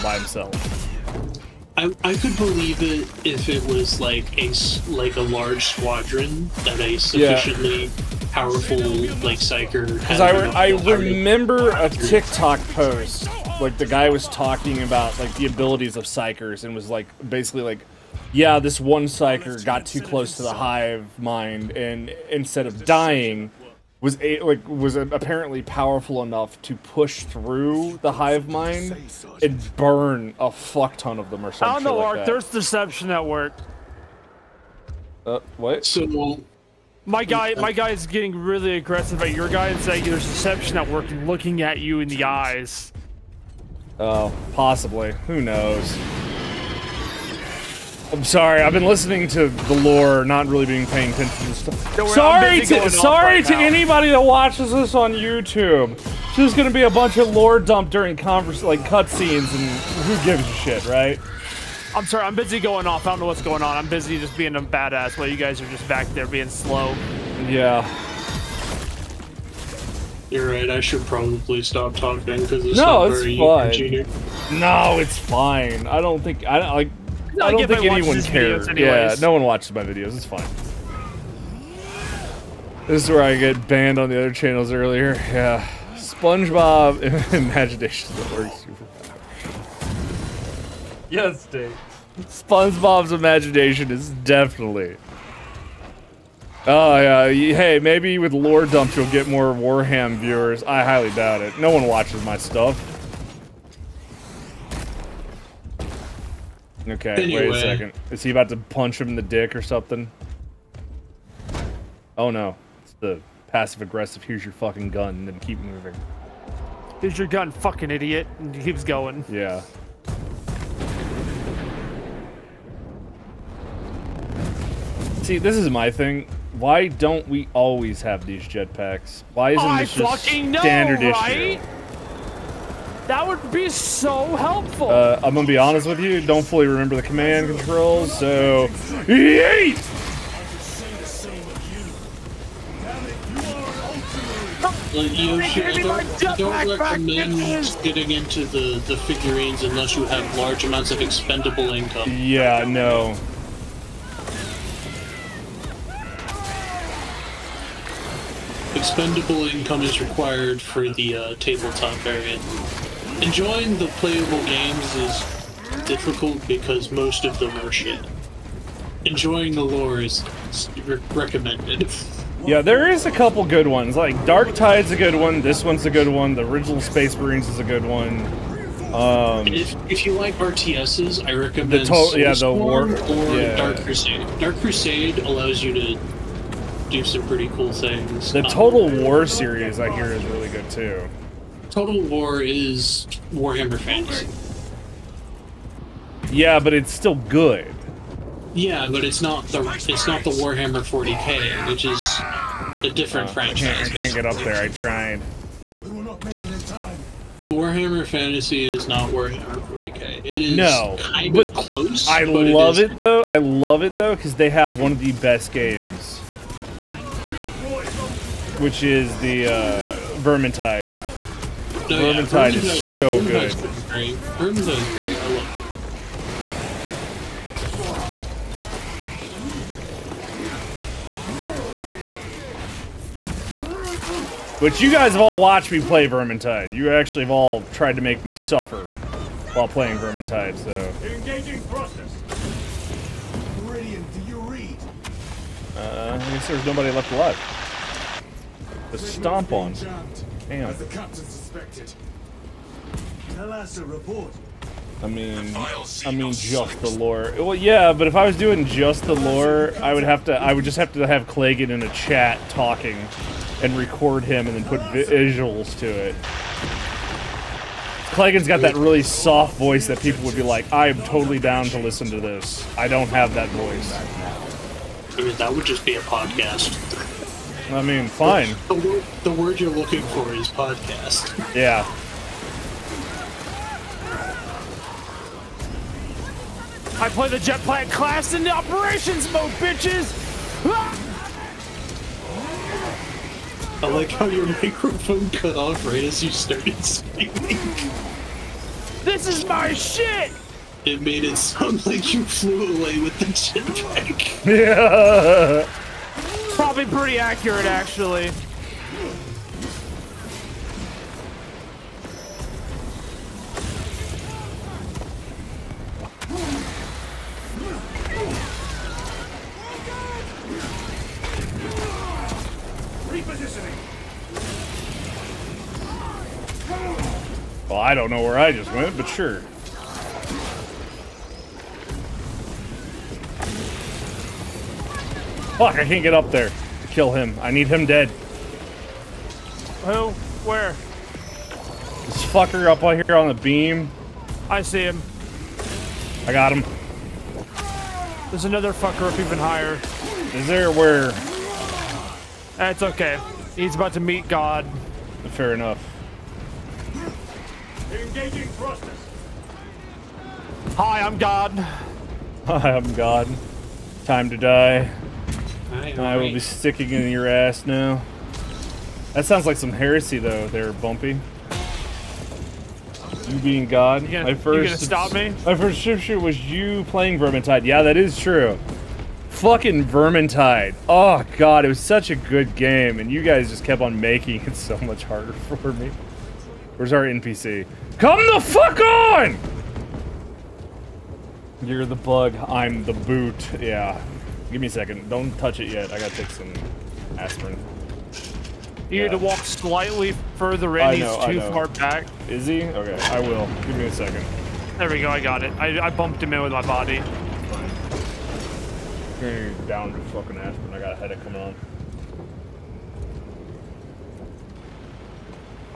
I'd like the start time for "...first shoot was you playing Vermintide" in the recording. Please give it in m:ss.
6:15.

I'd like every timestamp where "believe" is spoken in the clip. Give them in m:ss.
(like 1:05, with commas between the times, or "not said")
0:02.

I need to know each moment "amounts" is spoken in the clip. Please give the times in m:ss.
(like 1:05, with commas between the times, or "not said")
2:30.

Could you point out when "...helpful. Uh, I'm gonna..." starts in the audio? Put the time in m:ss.
2:14.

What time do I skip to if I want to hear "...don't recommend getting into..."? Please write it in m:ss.
2:26.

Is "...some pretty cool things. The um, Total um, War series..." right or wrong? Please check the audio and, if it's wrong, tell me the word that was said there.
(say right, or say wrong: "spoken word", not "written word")
right.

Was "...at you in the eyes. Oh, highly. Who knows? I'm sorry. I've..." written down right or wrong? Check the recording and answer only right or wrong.
wrong.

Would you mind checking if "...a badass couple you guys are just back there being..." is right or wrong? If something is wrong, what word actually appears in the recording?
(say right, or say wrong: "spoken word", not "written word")
wrong: "while", not "couple".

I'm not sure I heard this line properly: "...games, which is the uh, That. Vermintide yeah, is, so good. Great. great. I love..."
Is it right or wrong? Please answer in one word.
wrong.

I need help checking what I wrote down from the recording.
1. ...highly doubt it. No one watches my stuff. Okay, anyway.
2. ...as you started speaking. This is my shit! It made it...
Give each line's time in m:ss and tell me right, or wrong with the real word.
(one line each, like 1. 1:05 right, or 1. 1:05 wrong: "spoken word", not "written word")
1. 1:40 right
2. 4:56 right.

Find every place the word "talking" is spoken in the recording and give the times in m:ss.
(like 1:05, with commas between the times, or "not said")
0:14, 1:11, 4:22.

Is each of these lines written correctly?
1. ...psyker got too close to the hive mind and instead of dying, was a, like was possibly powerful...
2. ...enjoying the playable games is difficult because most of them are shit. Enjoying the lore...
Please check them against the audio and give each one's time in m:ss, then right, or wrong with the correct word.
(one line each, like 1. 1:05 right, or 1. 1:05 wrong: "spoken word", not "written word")
1. 0:19 wrong: "apparently", not "possibly"
2. 2:43 right.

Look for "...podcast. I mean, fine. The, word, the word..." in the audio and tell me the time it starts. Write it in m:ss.
4:35.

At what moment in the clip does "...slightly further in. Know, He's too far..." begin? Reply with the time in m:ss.
6:39.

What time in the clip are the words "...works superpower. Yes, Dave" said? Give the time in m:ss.
1:28.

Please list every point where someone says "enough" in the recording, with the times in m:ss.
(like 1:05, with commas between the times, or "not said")
0:26, 5:55.